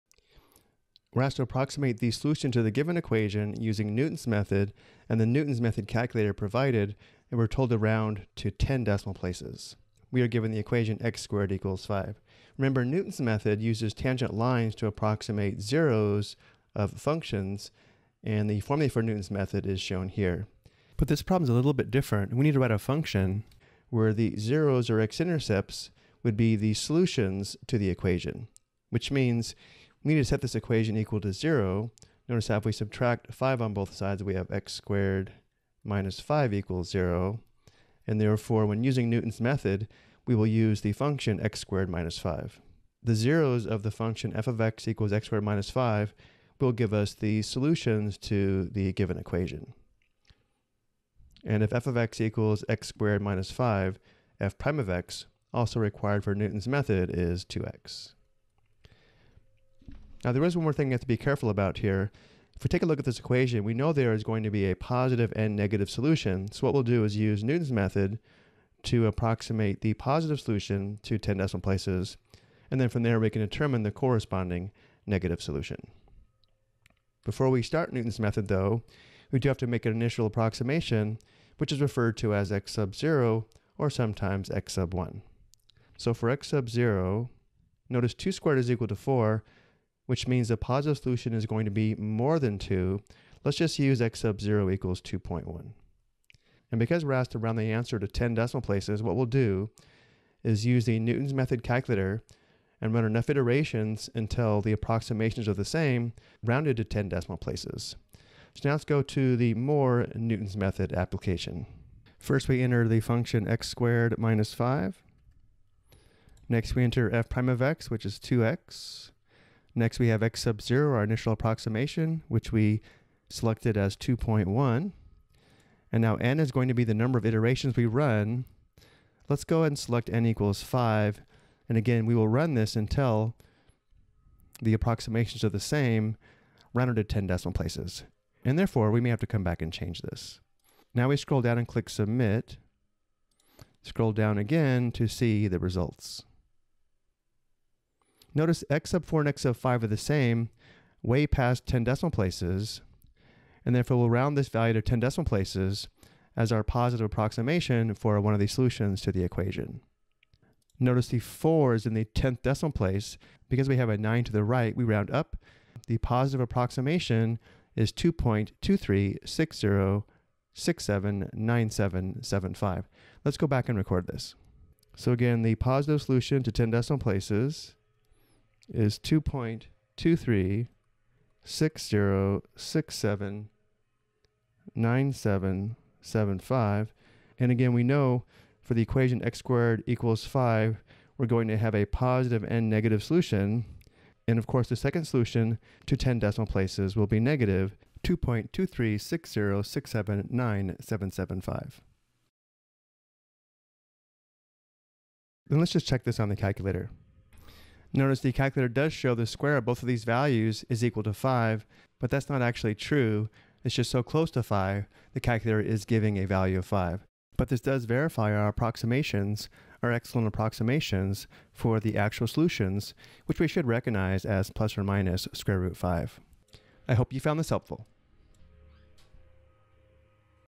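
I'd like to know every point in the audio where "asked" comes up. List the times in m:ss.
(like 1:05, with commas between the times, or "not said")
0:01, 1:37.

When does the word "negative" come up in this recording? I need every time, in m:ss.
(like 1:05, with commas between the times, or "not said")
1:05, 1:15, 3:12, 3:17.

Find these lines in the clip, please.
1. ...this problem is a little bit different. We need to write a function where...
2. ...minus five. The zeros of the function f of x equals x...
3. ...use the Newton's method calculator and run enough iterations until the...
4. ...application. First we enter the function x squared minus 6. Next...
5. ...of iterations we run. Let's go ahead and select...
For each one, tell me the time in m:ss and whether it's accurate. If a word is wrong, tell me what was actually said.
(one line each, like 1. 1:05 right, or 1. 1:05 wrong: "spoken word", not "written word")
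1. 0:21 right
2. 0:41 right
3. 1:40 right
4. 1:50 wrong: "5", not "6"
5. 2:07 right.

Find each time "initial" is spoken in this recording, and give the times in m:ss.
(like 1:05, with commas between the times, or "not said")
1:19, 2:01.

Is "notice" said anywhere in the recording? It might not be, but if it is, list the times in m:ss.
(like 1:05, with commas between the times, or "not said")
0:32, 1:27, 2:28, 2:40, 3:27.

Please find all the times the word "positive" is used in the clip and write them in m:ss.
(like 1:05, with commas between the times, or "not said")
1:04, 1:09, 1:30, 2:36, 2:45, 2:55, 3:11.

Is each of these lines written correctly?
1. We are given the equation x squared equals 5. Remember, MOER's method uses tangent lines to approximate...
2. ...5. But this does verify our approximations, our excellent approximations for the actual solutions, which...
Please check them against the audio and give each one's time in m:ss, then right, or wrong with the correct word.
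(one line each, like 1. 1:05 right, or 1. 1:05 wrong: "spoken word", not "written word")
1. 0:10 wrong: "Newton", not "MOER"
2. 3:36 right.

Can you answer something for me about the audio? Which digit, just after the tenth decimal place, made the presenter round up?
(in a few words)
9.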